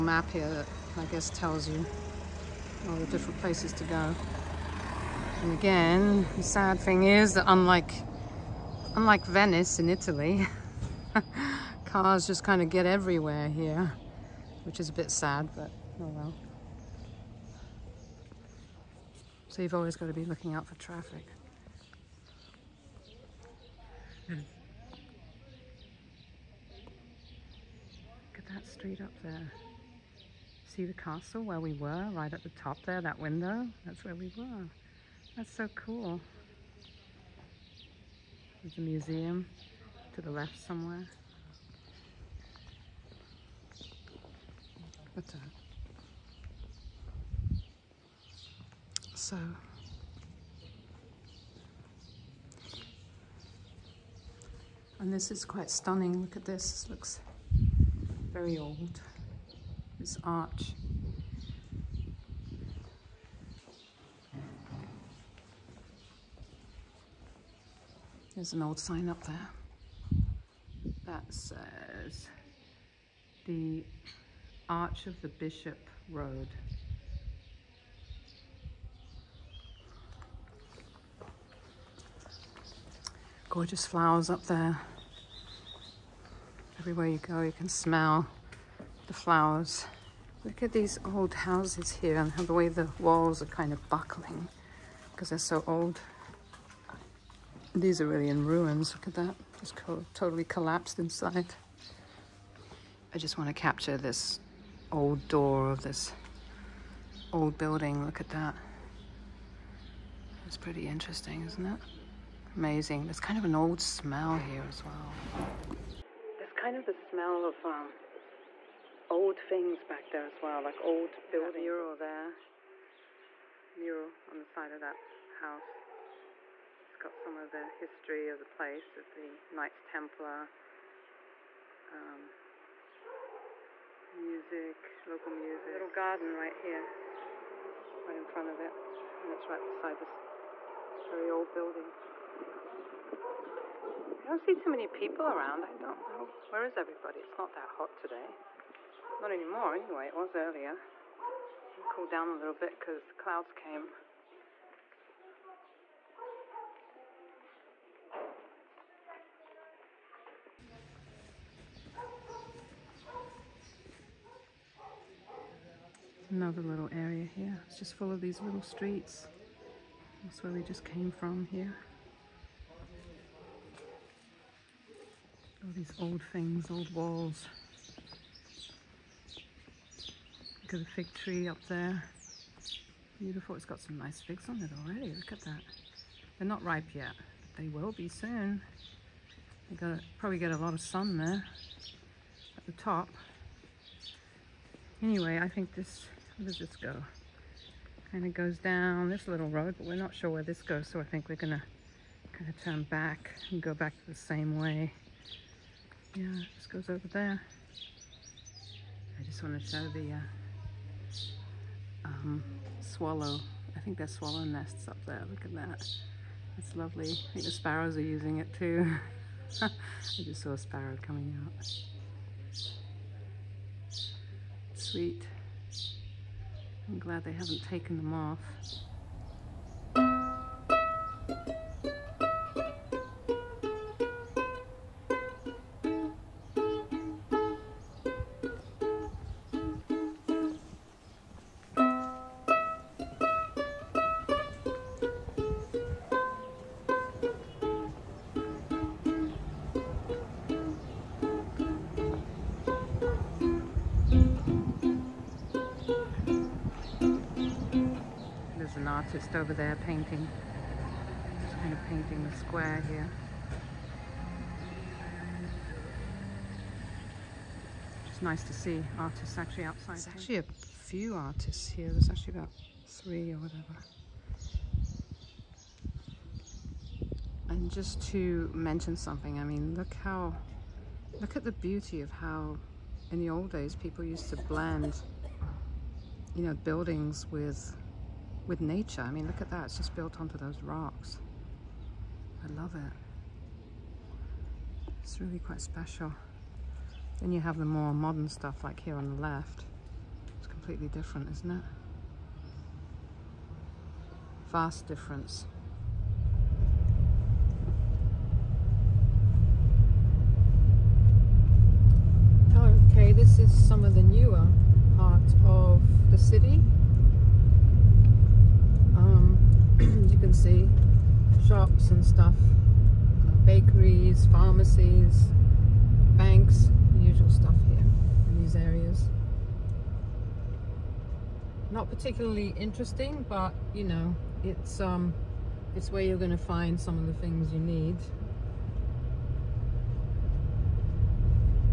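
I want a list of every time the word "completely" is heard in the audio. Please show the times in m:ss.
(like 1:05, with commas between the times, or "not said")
5:00.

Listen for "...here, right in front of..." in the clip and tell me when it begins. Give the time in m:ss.
2:16.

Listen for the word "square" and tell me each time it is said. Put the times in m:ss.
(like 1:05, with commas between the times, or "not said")
4:22.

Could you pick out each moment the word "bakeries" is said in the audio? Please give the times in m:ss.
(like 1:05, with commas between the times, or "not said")
5:23.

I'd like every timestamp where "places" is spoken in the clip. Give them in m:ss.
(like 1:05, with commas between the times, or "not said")
0:03, 2:08.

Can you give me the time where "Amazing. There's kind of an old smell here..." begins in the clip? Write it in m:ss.
1:52.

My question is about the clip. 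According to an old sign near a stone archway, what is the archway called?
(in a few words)
Arch of the Bishop Road.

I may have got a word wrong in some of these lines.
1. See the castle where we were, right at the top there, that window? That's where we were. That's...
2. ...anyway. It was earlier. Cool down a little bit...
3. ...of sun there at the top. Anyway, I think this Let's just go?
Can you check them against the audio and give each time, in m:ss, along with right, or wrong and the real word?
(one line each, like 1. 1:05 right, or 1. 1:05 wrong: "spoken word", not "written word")
1. 0:30 right
2. 2:29 right
3. 3:10 right.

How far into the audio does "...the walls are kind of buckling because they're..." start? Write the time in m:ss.
1:32.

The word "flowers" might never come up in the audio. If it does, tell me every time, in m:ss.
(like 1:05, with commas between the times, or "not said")
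1:23, 1:29.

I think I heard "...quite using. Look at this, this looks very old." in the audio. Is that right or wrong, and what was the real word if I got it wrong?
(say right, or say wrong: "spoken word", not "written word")
wrong: "stunning", not "using".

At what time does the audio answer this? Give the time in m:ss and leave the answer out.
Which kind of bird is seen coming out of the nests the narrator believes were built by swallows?
3:40.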